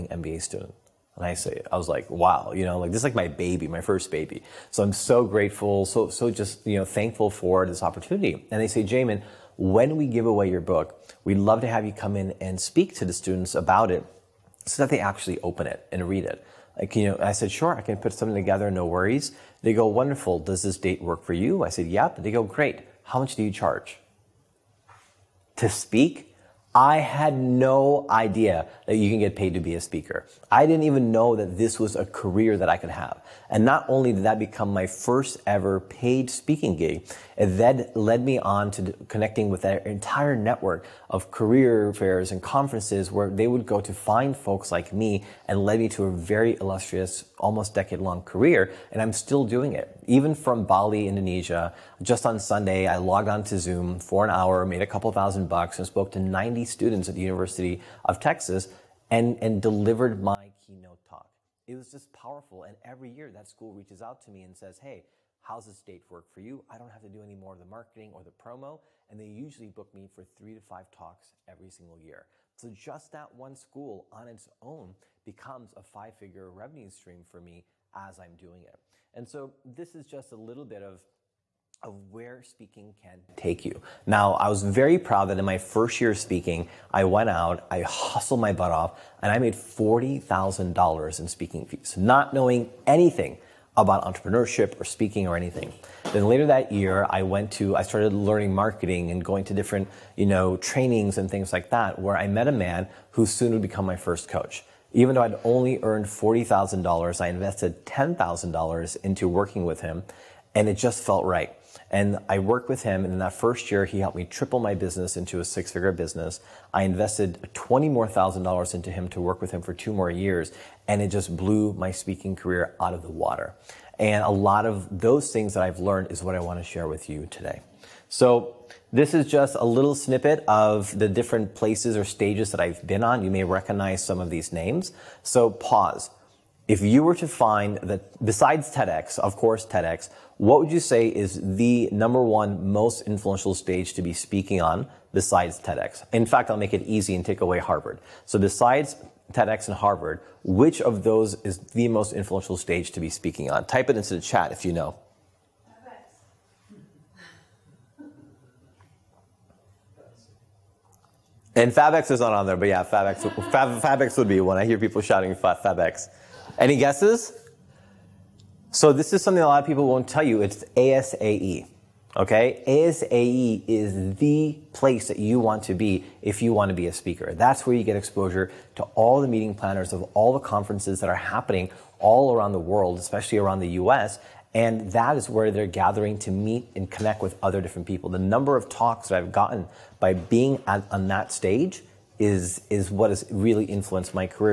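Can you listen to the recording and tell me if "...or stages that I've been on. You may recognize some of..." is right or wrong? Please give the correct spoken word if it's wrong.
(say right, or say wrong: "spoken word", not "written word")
right.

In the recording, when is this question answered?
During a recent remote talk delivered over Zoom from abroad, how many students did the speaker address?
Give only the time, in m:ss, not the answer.
0:56.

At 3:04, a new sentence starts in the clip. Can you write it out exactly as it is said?
And that is where they're gathering to meet and connect with other different people.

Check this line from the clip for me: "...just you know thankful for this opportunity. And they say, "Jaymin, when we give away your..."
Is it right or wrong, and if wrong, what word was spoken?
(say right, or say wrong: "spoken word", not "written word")
right.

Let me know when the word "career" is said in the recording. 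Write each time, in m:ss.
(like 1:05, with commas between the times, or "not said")
0:32, 0:41, 0:48, 2:02.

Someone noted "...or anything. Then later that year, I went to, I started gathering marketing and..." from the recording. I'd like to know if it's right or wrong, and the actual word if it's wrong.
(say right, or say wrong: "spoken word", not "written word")
wrong: "learning", not "gathering".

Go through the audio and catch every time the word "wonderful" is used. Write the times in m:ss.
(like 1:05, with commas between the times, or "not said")
0:19.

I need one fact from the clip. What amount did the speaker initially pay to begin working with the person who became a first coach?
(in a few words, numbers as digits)
$10,000.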